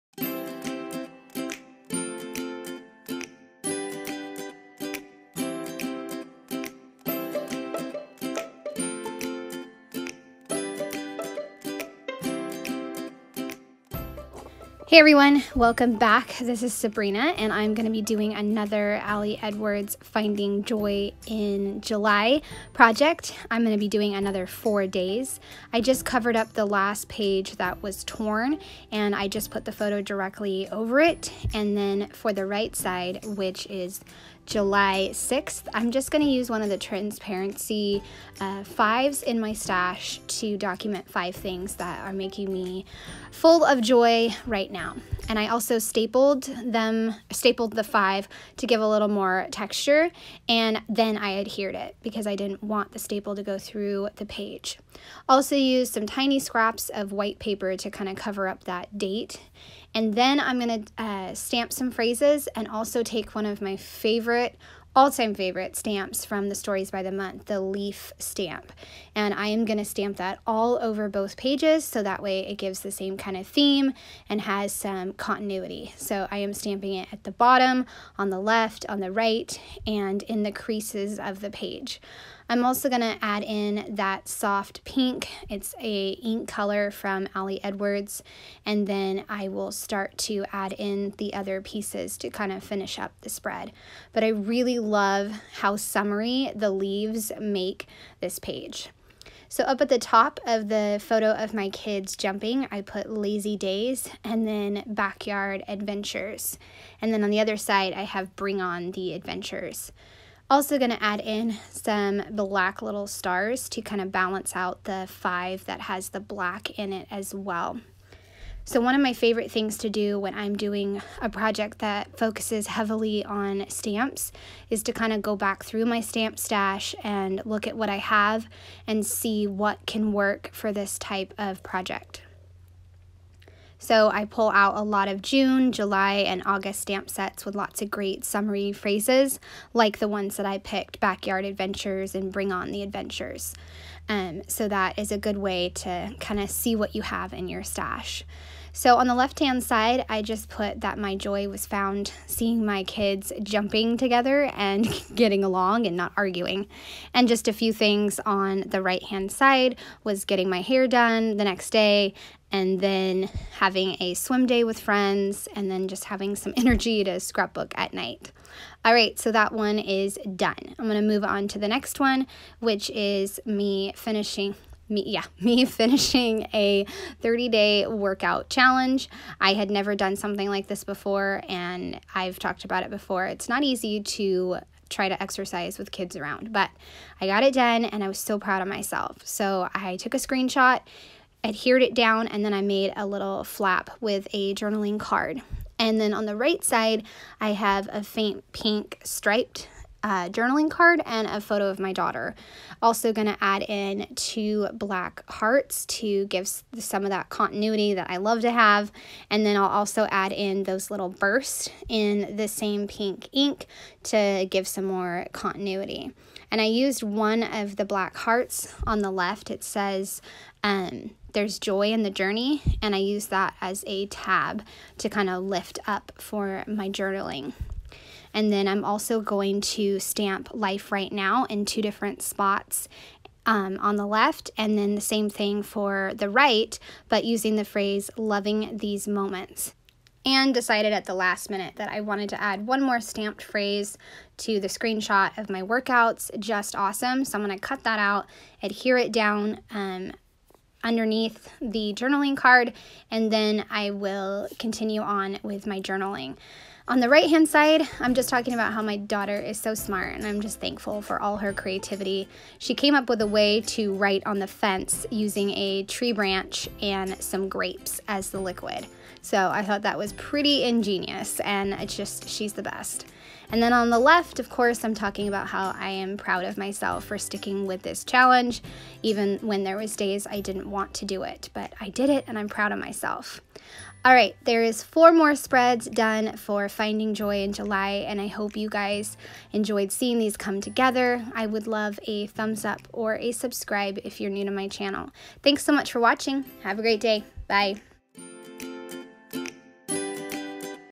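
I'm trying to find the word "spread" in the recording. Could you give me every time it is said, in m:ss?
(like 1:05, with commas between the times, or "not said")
1:33, 4:45.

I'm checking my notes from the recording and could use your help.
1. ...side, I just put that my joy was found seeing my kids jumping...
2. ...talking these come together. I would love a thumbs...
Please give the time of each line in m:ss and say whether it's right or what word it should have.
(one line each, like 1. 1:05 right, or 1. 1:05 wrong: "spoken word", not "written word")
1. 2:29 right
2. 4:49 wrong: "seeing", not "talking".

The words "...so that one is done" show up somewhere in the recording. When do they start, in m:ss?
2:49.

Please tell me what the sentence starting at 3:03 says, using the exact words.
It's not easy to try to exercise with kids around, but I got it done and I was so proud of myself.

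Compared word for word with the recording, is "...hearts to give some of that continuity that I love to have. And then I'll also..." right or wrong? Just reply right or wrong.
right.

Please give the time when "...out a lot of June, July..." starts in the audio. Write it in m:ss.
2:14.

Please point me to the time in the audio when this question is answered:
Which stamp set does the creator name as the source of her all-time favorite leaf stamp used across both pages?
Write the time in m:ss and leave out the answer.
1:06.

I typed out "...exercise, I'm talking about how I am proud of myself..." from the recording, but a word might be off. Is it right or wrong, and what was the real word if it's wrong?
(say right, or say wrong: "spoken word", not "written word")
wrong: "course", not "exercise".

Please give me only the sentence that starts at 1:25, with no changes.
It's a ink color from Ali Edwards.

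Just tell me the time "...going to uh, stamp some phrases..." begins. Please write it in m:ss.
1:00.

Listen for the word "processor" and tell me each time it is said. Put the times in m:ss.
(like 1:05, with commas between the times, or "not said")
not said.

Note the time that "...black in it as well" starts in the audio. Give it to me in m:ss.
1:56.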